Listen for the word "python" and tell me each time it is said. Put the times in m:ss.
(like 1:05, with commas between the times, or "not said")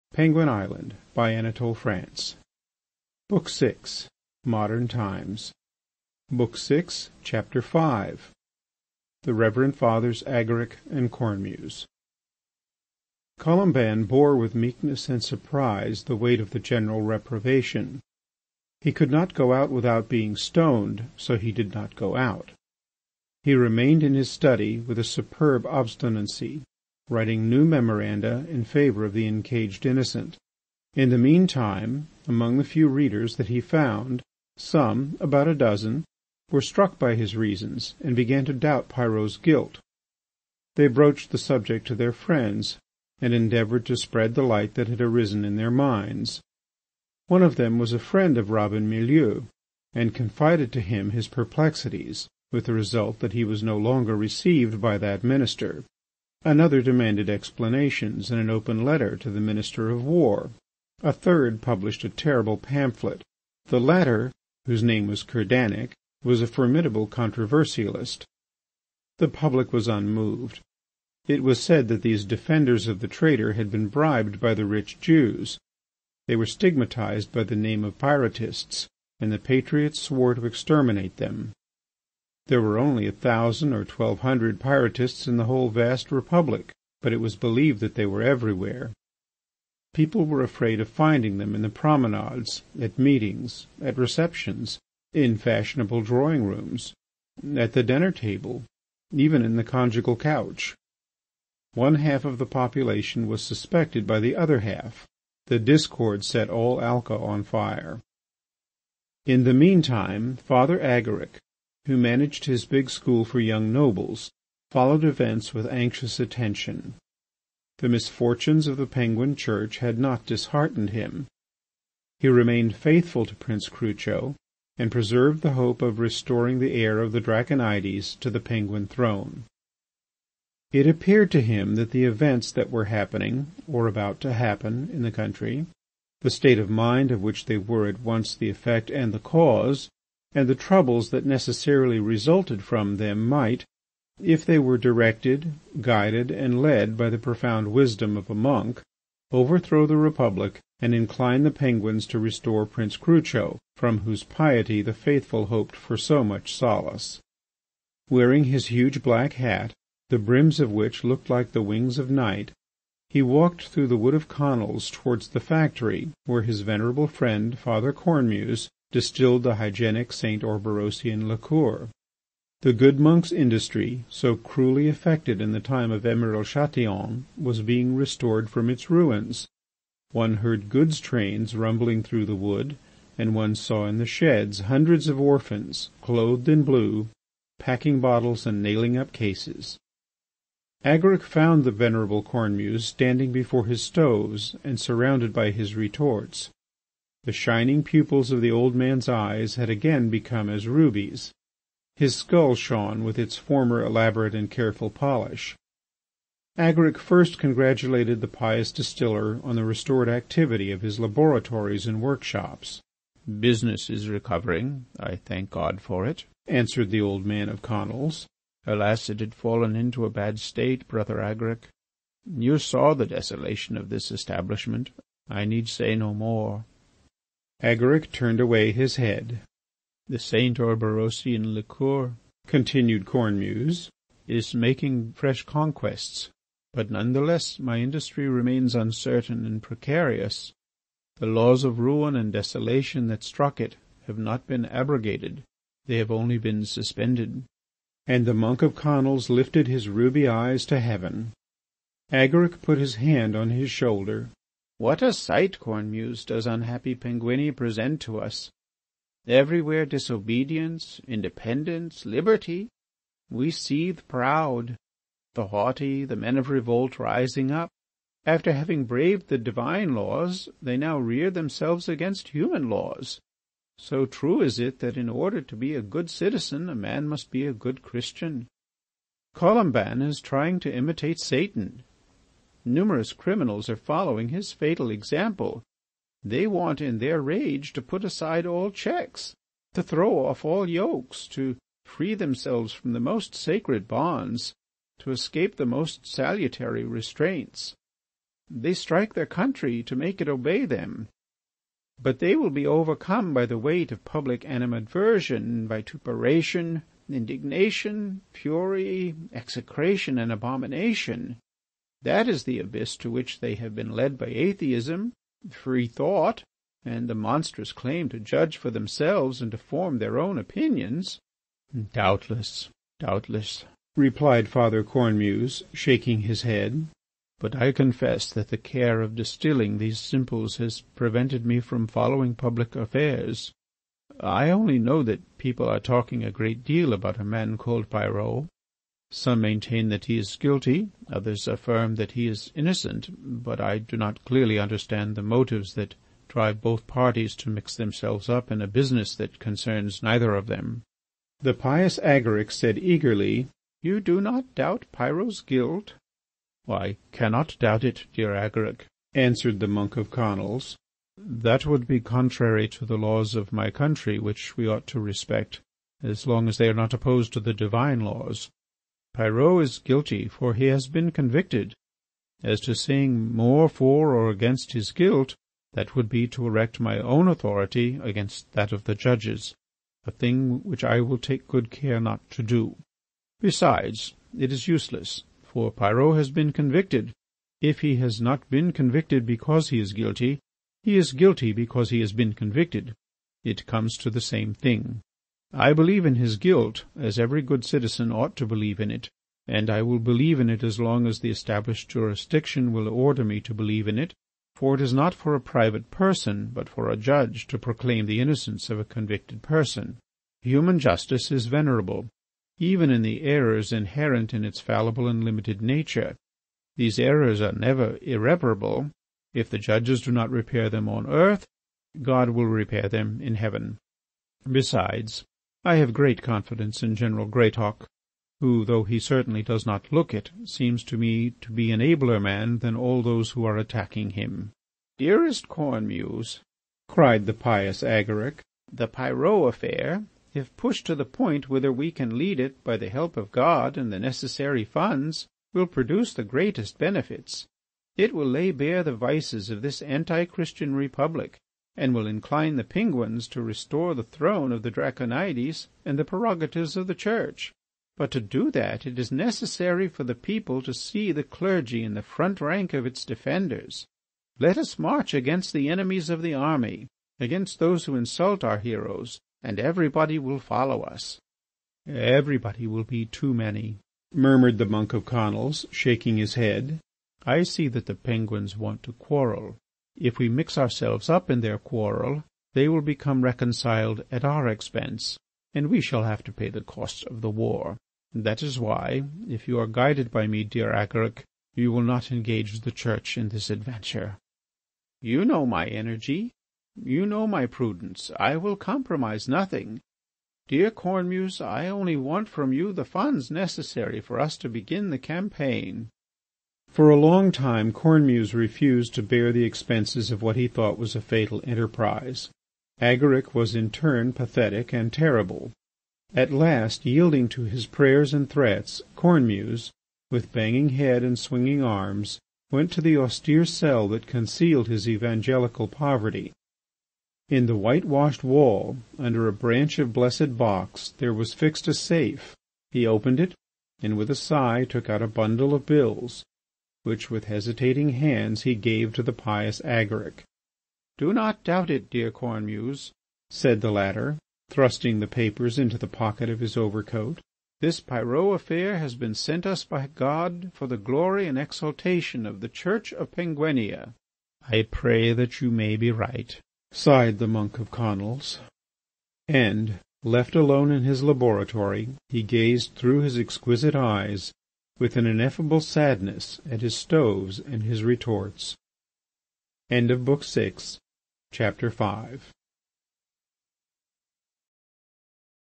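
not said.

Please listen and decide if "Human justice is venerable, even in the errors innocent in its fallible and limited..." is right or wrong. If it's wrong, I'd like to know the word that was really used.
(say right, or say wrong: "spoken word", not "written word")
wrong: "inherent", not "innocent".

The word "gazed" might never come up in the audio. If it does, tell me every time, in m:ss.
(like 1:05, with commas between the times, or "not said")
9:22.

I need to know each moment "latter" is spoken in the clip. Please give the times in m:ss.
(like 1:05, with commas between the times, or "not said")
1:03, 9:03.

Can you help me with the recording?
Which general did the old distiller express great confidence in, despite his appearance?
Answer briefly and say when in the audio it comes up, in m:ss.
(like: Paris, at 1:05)
General Greathawk, at 7:06.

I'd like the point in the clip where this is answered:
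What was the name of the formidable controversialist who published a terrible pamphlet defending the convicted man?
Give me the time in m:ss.
1:05.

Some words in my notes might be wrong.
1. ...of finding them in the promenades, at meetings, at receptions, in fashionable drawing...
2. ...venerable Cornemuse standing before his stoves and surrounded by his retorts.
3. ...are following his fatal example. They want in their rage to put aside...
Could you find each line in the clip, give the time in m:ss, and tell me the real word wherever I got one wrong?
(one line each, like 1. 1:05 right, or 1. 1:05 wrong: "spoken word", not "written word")
1. 1:30 right
2. 3:11 right
3. 4:43 right.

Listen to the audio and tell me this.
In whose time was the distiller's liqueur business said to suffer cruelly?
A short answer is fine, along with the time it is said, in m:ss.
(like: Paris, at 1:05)
Emeril Chatillon, at 2:56.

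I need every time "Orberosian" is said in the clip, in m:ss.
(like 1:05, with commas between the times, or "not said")
2:50, 3:50.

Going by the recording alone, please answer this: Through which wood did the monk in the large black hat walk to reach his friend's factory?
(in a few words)
wood of Conils.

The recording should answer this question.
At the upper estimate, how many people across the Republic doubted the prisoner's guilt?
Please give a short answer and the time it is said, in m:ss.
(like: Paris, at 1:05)
1200, at 1:23.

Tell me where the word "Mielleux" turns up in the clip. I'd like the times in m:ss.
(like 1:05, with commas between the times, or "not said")
0:48.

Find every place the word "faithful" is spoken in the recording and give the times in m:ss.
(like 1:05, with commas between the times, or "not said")
2:02, 2:34.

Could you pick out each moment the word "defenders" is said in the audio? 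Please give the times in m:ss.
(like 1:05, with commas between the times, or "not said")
1:12, 7:43.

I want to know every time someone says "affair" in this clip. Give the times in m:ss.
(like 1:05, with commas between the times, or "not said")
5:32, 7:19, 9:08.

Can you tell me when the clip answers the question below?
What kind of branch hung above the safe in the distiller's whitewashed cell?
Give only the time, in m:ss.
8:49.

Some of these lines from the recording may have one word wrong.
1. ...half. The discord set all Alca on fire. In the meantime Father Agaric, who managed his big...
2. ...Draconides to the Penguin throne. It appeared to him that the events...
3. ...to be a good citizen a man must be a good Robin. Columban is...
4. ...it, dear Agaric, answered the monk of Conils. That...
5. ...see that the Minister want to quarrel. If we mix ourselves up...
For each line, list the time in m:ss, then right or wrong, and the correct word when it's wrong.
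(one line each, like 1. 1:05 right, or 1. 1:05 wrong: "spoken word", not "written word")
1. 1:44 right
2. 2:07 right
3. 4:35 wrong: "Christian", not "Robin"
4. 5:57 right
5. 7:57 wrong: "Penguins", not "Minister".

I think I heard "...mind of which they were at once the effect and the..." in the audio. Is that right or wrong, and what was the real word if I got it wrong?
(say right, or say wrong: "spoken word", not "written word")
right.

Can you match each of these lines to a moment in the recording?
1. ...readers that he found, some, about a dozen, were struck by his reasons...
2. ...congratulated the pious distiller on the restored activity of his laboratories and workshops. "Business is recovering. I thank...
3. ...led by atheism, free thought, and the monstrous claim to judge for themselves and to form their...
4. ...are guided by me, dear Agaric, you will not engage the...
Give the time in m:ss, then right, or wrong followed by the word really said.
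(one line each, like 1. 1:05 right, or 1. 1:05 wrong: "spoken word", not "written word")
1. 0:32 right
2. 3:27 right
3. 5:13 right
4. 8:09 right.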